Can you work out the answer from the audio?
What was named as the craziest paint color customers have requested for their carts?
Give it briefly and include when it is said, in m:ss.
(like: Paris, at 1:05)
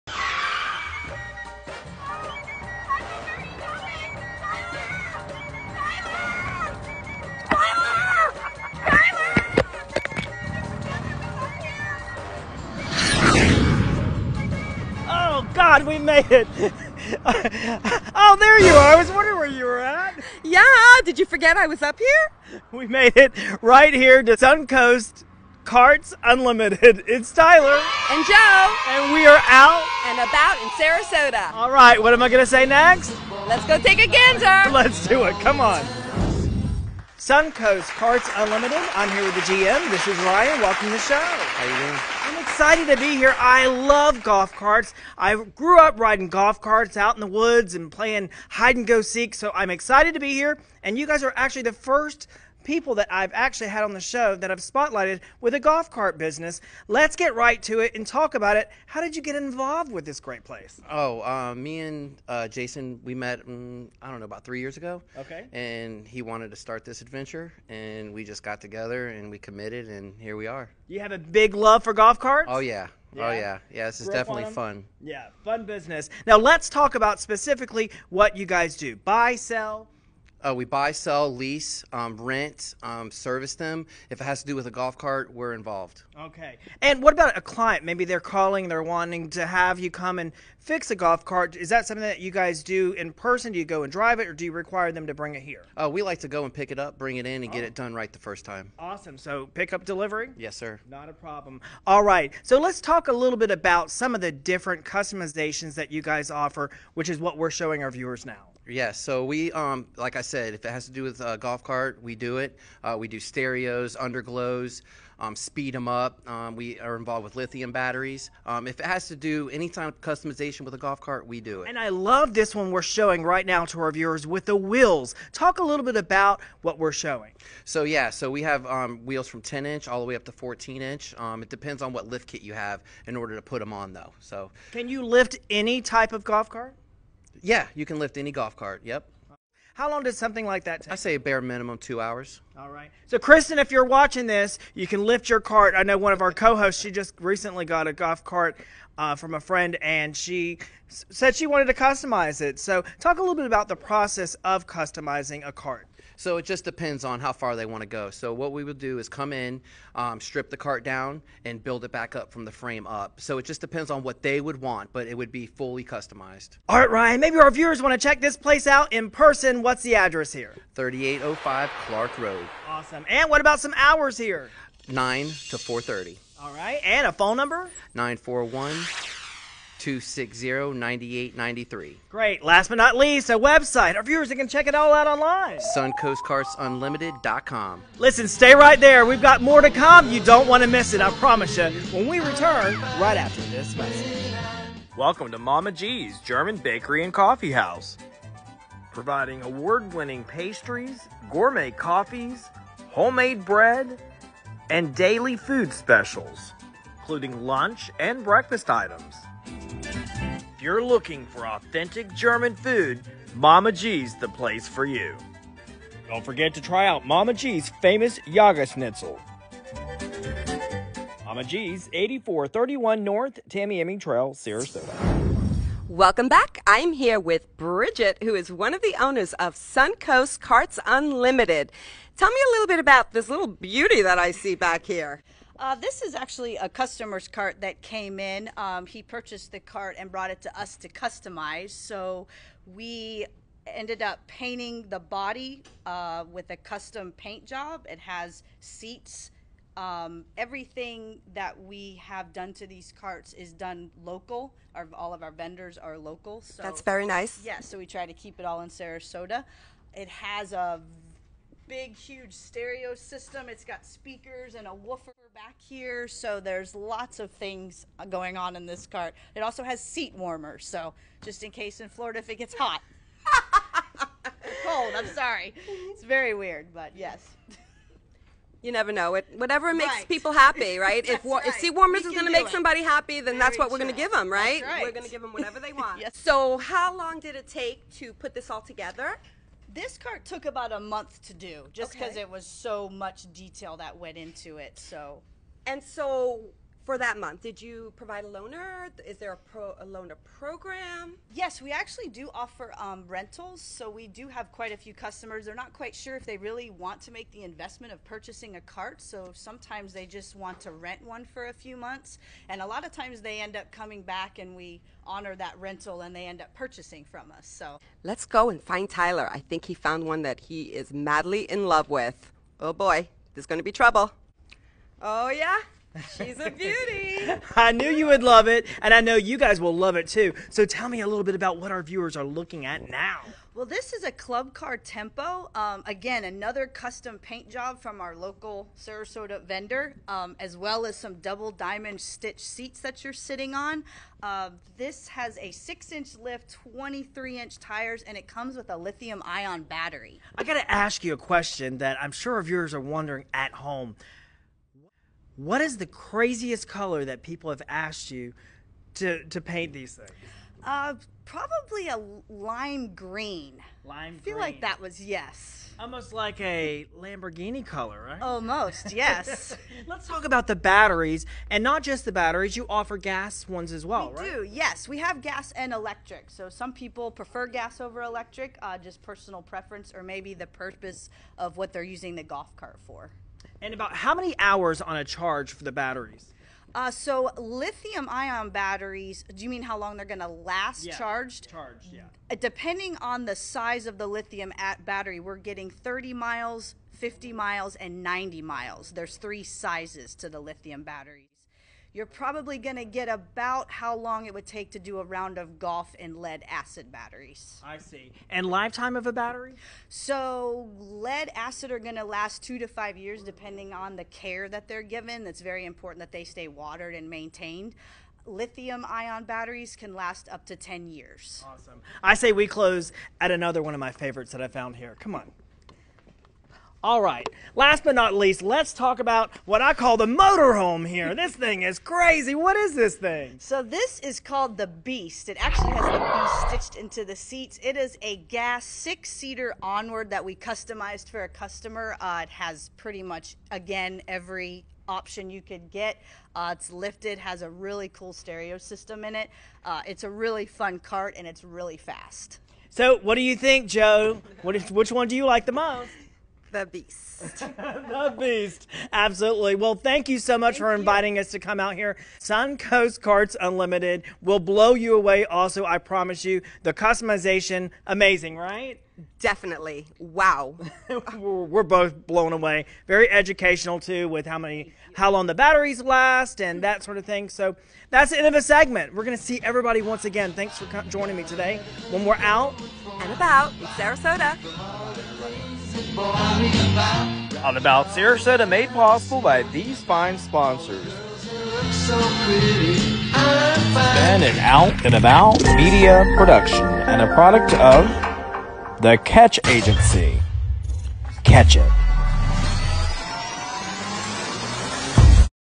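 Lime green, at 6:02.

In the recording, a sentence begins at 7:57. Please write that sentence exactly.
So that's the end of a segment.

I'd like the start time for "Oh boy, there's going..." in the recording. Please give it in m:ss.
5:22.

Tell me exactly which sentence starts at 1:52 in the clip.
Uh, we do stereos, underglows, um, speed them up.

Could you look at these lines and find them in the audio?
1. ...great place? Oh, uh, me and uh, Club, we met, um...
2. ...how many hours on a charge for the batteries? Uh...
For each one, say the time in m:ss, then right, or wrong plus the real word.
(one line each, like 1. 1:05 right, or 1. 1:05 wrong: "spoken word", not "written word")
1. 1:00 wrong: "Jason", not "Club"
2. 6:23 right.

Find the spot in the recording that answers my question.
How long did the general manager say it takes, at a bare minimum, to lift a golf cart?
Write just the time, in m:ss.
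2:21.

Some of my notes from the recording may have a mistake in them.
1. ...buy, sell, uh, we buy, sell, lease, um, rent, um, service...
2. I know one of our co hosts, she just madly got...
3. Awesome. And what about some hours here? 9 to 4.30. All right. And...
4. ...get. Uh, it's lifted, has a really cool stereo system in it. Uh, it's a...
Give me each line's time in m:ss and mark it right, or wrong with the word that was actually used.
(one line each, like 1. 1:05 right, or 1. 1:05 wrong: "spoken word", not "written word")
1. 1:18 right
2. 2:25 wrong: "recently", not "madly"
3. 2:52 right
4. 7:25 right.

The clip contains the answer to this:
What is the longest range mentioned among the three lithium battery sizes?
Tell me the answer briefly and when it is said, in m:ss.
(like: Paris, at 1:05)
90 miles, at 6:38.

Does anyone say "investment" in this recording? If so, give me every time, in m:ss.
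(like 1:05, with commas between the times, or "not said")
5:07.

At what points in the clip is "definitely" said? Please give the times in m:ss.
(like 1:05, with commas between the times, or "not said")
1:14, 7:49.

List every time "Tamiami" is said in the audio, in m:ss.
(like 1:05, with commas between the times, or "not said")
3:43.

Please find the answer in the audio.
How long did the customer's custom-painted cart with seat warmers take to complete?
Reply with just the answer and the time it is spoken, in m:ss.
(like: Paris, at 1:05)
About a month, at 4:50.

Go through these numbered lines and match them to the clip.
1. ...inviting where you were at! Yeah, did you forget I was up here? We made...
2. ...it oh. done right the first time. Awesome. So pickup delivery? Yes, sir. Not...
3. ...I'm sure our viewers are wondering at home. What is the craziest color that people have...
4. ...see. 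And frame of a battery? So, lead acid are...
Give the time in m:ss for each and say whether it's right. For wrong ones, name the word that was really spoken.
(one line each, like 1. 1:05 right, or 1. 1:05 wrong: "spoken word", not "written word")
1. 0:19 wrong: "wondering", not "inviting"
2. 1:37 right
3. 5:52 right
4. 6:47 wrong: "lifetime", not "frame".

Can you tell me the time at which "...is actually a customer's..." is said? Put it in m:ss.
3:56.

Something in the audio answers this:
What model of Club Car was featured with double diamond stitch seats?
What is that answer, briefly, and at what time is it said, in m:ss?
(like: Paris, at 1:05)
Tempo, at 5:34.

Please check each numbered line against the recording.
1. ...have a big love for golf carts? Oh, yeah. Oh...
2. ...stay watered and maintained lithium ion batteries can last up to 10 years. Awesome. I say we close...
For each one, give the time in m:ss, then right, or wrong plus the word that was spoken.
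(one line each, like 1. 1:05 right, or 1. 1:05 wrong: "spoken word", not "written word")
1. 1:10 right
2. 6:56 right.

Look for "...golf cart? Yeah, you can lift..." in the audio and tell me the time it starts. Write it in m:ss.
2:16.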